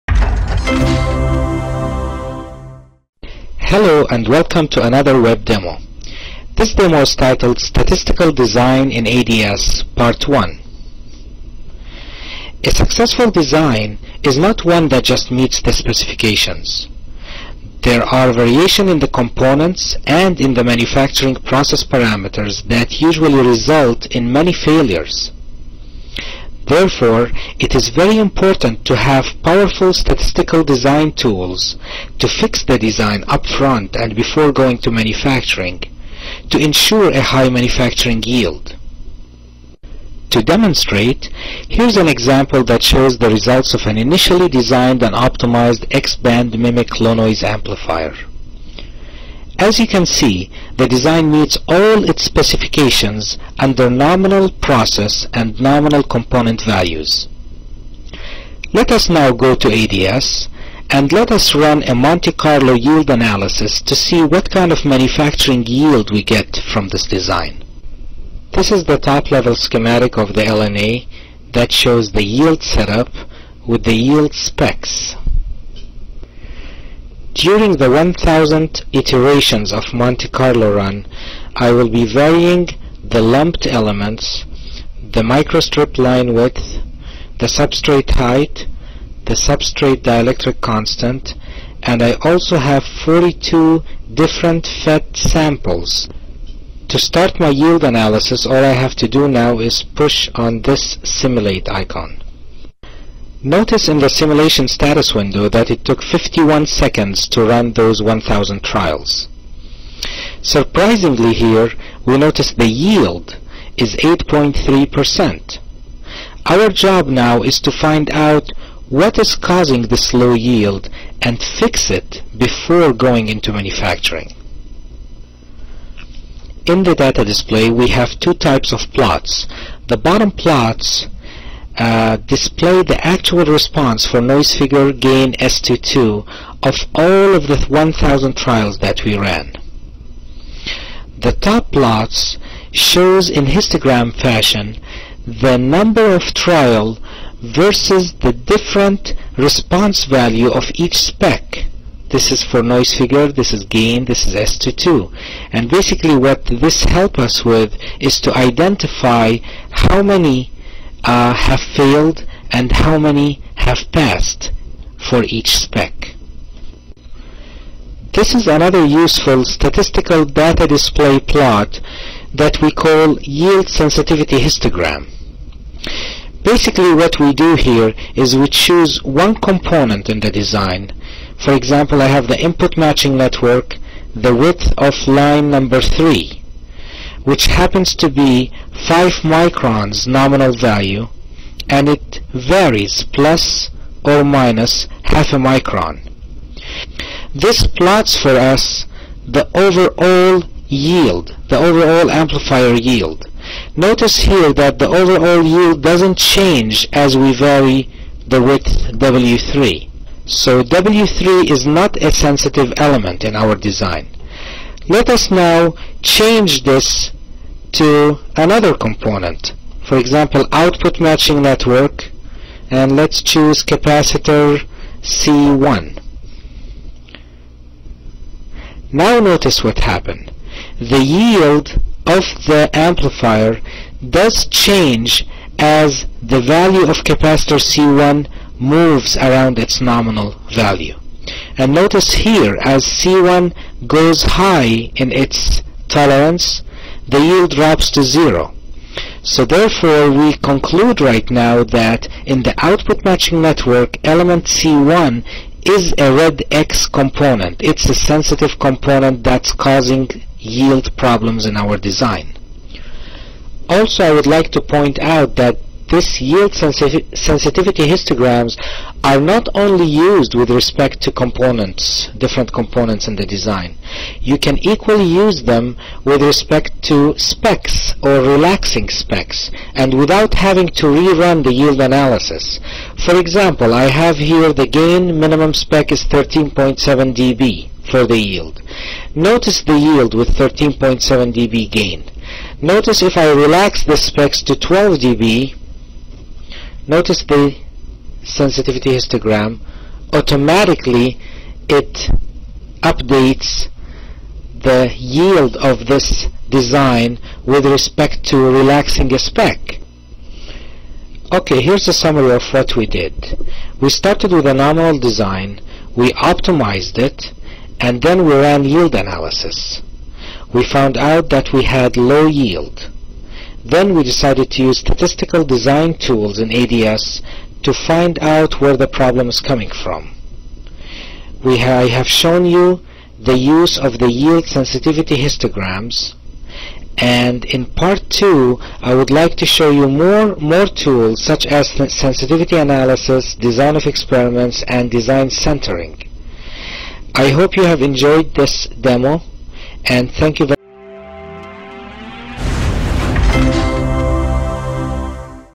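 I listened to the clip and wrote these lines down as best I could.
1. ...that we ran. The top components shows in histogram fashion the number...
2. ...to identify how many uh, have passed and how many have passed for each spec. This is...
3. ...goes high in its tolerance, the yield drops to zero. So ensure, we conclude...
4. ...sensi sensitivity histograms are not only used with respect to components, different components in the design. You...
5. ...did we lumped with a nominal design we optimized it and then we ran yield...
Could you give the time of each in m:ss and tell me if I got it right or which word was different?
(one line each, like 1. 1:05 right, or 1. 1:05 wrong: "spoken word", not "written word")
1. 2:18 wrong: "plots", not "components"
2. 2:38 wrong: "failed", not "passed"
3. 4:03 wrong: "therefore", not "ensure"
4. 4:26 right
5. 5:12 wrong: "started", not "lumped".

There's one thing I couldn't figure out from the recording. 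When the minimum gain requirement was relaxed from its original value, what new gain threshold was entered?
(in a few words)
12 dB.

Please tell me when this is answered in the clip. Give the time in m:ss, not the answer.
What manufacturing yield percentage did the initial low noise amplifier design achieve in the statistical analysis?
1:53.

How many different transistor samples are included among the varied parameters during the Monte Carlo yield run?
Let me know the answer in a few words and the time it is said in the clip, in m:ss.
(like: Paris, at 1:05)
42, at 1:32.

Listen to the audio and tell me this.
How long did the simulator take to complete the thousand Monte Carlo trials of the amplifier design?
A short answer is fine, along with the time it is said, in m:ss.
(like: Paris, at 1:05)
51 seconds, at 1:46.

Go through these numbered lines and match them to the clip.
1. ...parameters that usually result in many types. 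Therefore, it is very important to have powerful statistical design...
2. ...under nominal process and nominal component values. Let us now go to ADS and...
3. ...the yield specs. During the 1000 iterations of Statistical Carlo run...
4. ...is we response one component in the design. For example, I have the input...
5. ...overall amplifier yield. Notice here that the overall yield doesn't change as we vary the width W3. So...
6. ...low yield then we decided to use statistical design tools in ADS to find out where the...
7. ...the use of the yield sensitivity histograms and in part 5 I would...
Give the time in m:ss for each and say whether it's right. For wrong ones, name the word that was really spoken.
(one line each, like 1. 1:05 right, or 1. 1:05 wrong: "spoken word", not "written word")
1. 0:21 wrong: "failures", not "types"
2. 0:53 right
3. 1:13 wrong: "Monte", not "Statistical"
4. 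2:58 wrong: "choose", not "response"
5. 3:21 right
6. 5:21 right
7. 5:33 wrong: "2", not "5".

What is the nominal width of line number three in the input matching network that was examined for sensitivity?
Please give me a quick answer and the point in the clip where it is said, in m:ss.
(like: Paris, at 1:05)
5 microns, at 3:08.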